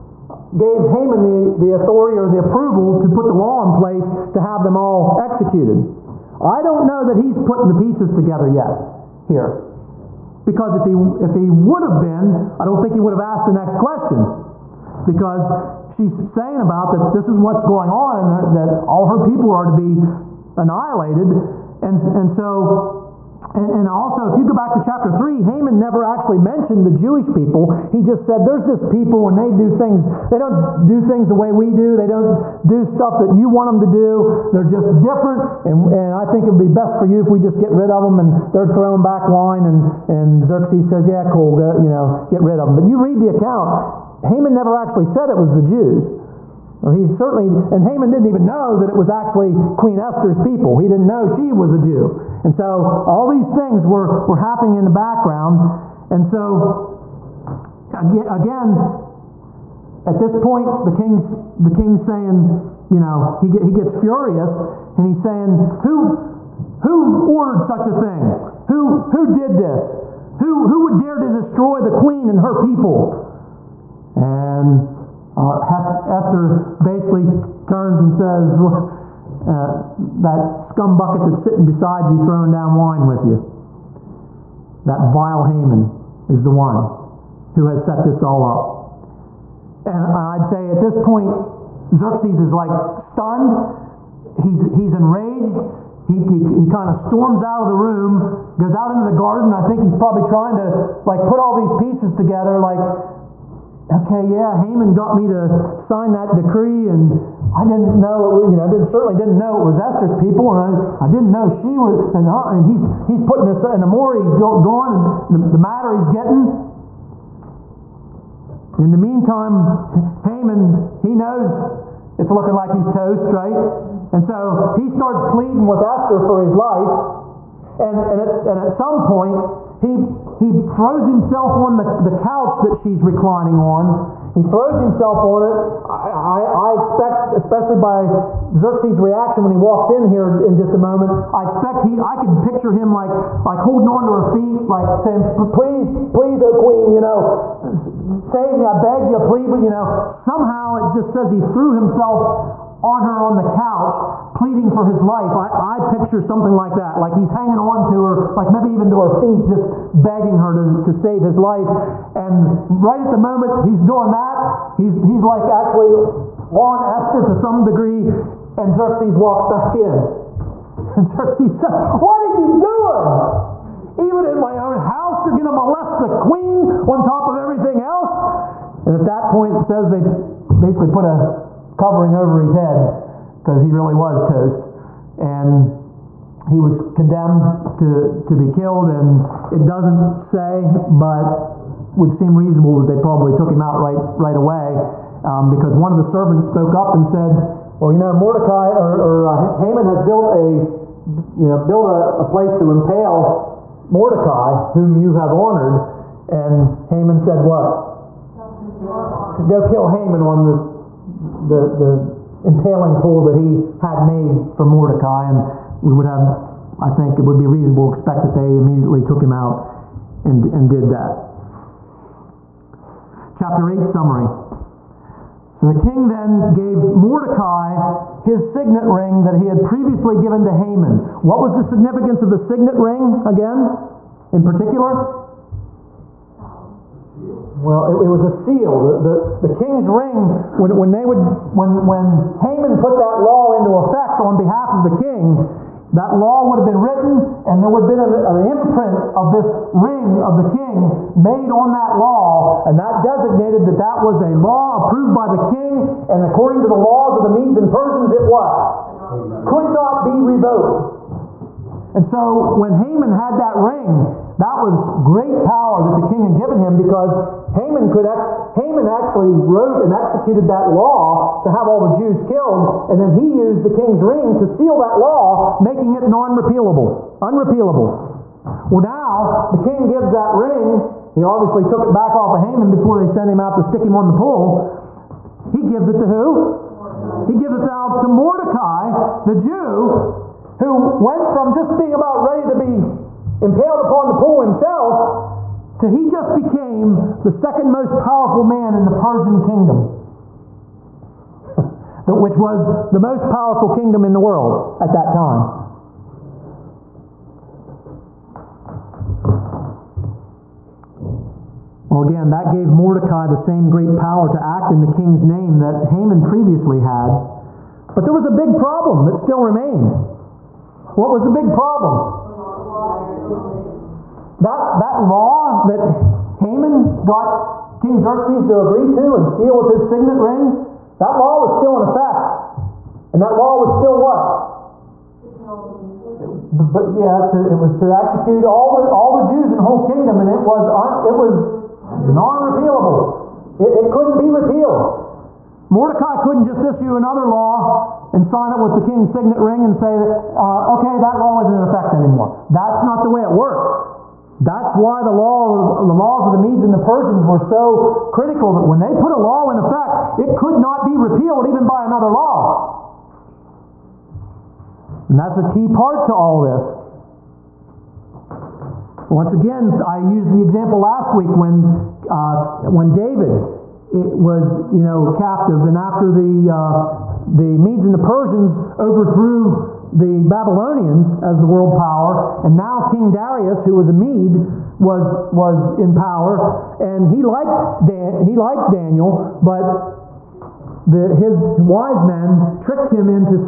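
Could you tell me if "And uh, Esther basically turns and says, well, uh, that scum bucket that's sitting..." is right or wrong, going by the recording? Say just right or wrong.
right.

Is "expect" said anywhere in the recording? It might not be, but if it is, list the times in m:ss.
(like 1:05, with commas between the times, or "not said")
2:16, 2:21, 3:37.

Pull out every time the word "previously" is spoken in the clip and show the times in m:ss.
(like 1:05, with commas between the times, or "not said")
3:49, 5:16.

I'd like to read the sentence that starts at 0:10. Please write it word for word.
Because if he, if he would have been, I don't think he would have asked the next question.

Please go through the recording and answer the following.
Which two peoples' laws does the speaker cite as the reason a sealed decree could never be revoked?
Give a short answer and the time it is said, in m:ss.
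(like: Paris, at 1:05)
The Medes and Persians, at 4:17.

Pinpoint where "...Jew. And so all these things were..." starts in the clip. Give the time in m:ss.
0:51.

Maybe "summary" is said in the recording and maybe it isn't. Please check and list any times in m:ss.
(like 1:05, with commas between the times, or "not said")
3:43.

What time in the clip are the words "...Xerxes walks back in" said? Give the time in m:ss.
2:48.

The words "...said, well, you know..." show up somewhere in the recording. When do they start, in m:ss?
3:17.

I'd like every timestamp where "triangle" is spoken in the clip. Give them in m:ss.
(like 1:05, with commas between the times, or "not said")
not said.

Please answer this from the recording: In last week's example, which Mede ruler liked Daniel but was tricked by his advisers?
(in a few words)
King Darius.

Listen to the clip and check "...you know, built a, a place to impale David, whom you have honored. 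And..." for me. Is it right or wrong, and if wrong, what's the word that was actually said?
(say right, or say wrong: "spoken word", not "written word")
wrong: "Mordecai", not "David".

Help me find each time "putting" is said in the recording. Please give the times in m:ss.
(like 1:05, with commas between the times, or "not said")
0:07, 1:53.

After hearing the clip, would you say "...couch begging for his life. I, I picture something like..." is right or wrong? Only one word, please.
wrong.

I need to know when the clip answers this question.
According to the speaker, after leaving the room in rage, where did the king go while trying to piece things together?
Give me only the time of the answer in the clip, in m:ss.
1:39.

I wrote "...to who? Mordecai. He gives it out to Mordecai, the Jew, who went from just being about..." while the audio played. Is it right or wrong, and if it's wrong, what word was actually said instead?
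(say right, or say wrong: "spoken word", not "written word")
right.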